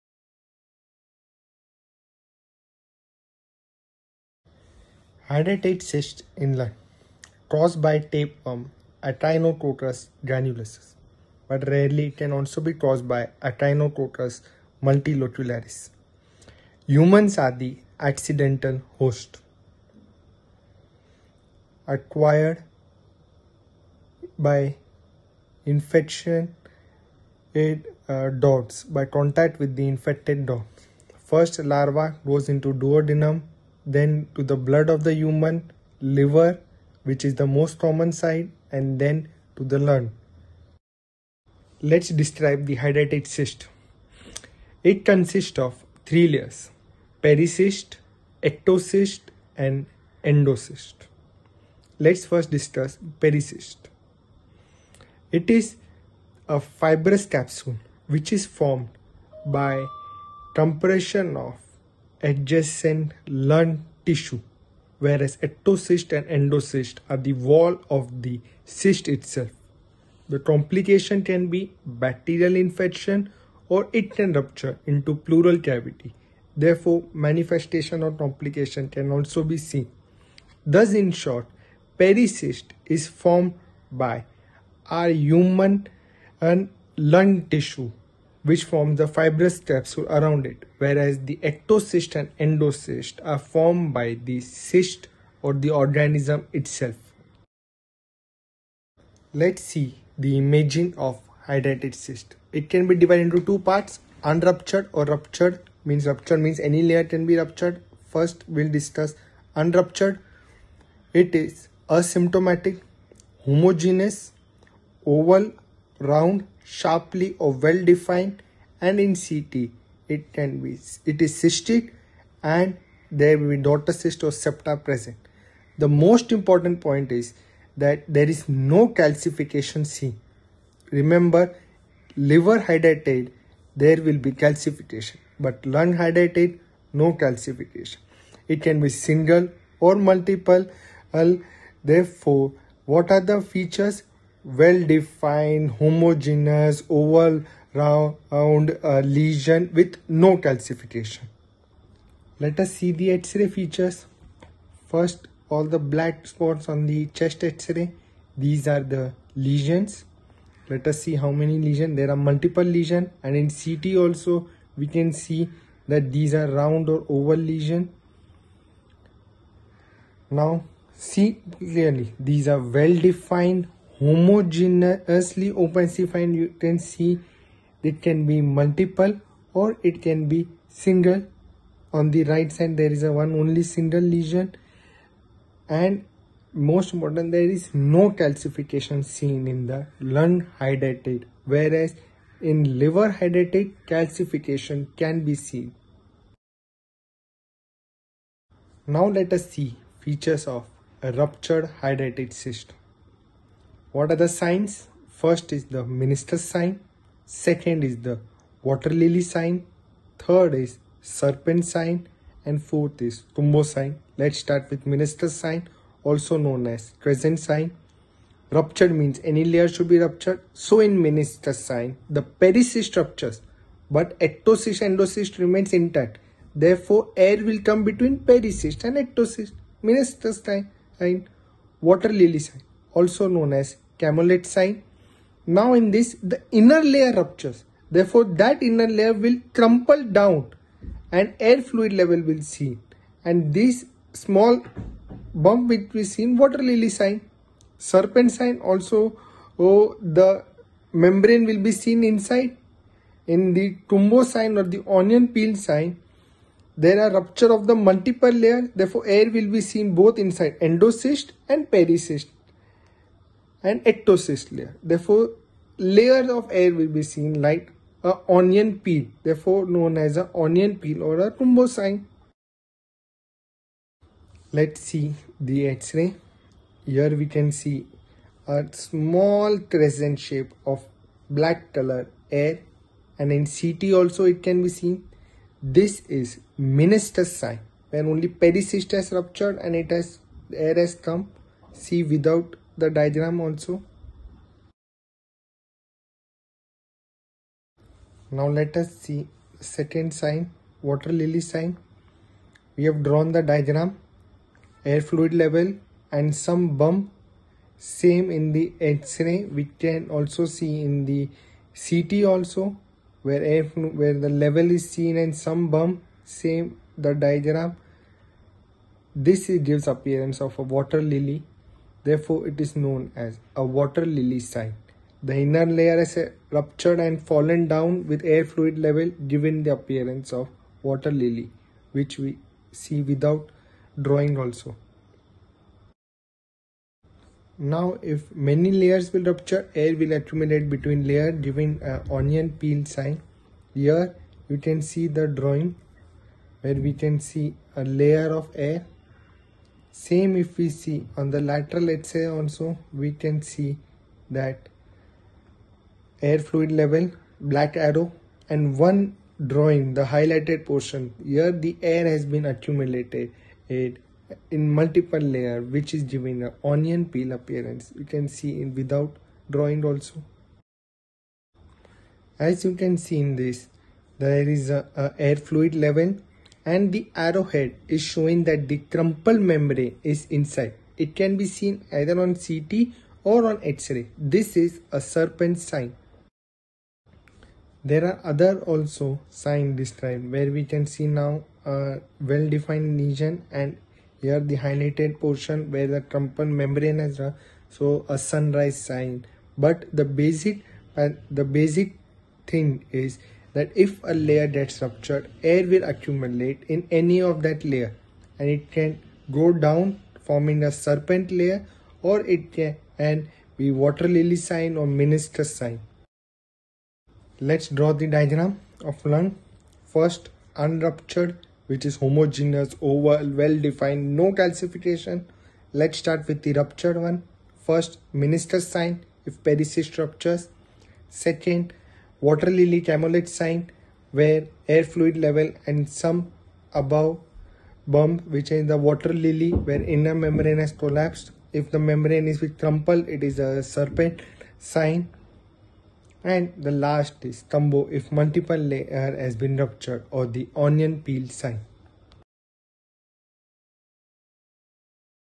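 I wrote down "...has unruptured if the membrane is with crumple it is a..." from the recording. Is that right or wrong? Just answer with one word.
wrong.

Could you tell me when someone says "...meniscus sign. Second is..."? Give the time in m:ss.
3:25.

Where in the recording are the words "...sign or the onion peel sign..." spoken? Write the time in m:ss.
4:14.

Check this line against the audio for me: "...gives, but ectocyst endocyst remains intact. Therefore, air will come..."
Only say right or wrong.
wrong.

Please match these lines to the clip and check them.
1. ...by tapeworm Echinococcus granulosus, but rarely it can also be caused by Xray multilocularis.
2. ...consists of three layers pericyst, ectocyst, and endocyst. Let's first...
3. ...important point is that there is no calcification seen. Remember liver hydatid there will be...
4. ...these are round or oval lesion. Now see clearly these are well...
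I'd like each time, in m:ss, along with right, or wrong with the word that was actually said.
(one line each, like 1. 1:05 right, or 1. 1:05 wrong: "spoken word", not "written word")
1. 0:07 wrong: "Echinococcus", not "Xray"
2. 0:45 right
3. 2:06 right
4. 2:46 right.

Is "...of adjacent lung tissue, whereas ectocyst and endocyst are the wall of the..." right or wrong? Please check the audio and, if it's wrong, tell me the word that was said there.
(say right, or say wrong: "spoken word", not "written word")
right.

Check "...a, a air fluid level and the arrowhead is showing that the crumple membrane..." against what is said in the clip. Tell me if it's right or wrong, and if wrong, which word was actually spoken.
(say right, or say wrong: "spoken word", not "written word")
right.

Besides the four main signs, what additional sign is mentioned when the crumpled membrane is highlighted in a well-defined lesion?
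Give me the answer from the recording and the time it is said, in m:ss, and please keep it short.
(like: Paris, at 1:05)
Sunrise sign, at 6:38.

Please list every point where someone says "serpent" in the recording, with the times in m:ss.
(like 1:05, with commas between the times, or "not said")
3:31, 4:07, 6:25, 6:50, 7:23.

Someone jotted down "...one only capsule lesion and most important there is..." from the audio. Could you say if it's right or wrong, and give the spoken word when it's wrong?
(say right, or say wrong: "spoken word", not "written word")
wrong: "single", not "capsule".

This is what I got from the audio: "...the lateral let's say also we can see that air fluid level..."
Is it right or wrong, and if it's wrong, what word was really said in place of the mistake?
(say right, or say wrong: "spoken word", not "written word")
right.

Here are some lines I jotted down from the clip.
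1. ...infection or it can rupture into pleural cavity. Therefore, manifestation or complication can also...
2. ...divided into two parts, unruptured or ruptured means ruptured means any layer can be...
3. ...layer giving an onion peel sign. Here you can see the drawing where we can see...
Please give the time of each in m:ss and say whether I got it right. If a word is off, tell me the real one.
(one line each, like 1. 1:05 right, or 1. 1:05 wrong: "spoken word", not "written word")
1. 1:12 right
2. 1:42 right
3. 5:41 right.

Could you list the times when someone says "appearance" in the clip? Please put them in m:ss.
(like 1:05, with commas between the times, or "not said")
5:19, 5:29, 6:07.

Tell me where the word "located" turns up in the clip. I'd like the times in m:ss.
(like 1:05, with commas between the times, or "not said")
not said.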